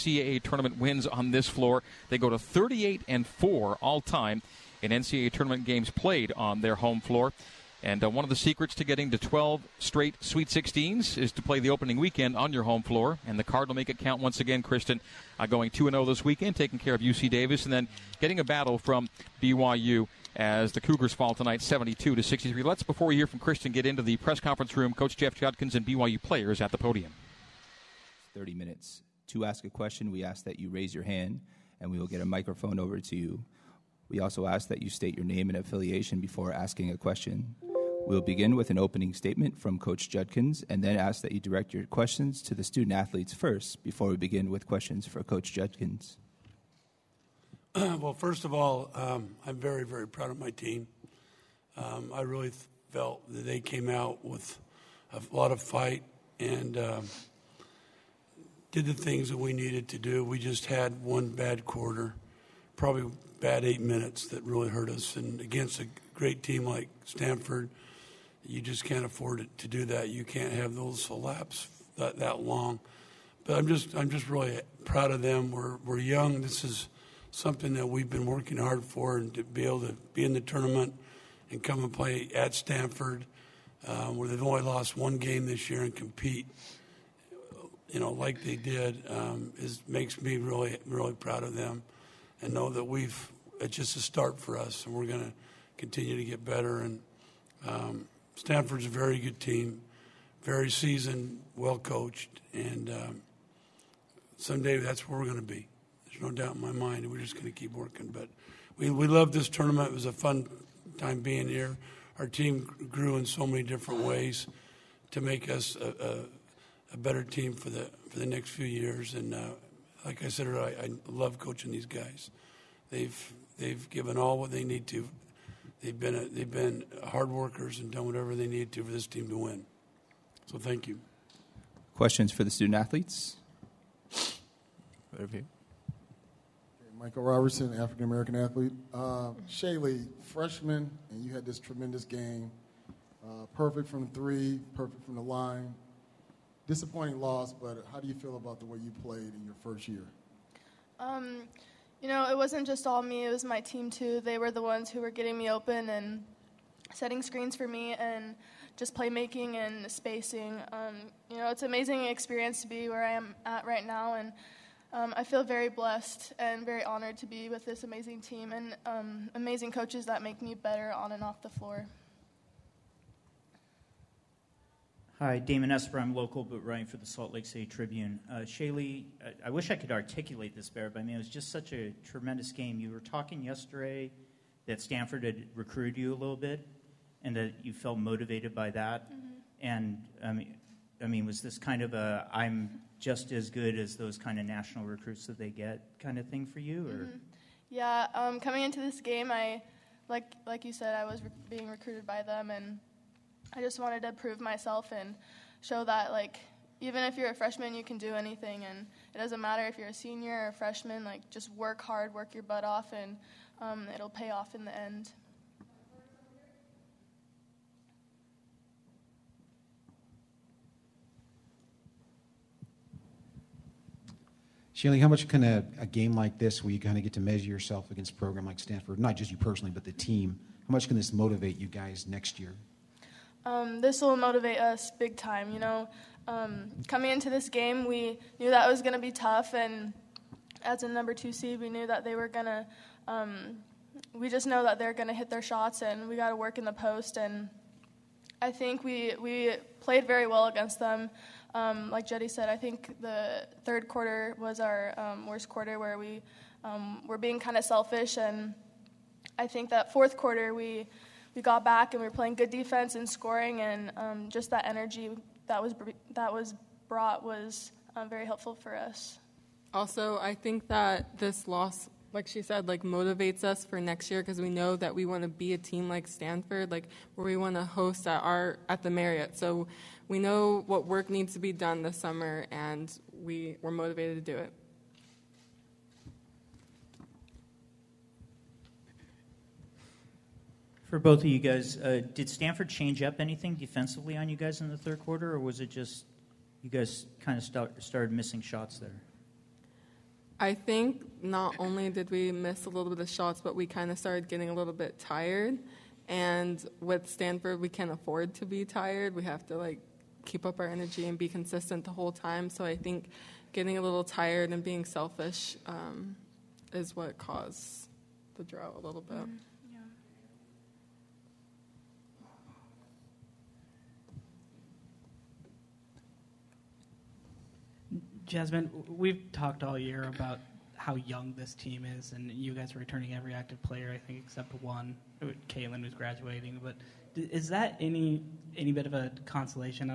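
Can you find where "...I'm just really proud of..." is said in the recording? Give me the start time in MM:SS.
01:13.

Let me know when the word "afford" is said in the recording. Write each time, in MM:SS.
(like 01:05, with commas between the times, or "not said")
01:09, 05:07.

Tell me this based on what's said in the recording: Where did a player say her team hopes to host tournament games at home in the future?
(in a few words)
The Marriott.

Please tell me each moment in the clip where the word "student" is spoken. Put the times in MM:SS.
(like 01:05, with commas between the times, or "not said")
00:42, 02:12.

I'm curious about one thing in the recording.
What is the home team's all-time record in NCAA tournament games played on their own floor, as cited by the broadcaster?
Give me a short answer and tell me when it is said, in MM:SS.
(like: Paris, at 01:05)
38-4, at 00:02.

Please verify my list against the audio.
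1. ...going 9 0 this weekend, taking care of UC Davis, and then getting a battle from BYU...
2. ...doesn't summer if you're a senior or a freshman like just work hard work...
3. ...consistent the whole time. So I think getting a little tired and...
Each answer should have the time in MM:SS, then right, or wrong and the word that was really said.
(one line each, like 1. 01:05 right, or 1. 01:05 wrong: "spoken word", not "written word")
1. 00:15 wrong: "2", not "9"
2. 03:29 wrong: "matter", not "summer"
3. 05:11 right.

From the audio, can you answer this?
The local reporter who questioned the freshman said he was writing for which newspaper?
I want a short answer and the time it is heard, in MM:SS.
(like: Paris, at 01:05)
Salt Lake City Tribune, at 02:57.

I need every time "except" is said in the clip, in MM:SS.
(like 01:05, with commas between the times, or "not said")
05:34.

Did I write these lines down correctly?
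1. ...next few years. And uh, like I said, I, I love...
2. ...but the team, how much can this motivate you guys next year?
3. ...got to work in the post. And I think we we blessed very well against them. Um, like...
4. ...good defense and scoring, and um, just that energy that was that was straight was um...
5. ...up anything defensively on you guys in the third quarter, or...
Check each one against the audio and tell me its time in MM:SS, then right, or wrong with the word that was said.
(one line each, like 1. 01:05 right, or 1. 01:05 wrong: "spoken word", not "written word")
1. 01:58 right
2. 03:49 right
3. 04:06 wrong: "played", not "blessed"
4. 04:22 wrong: "brought", not "straight"
5. 04:53 right.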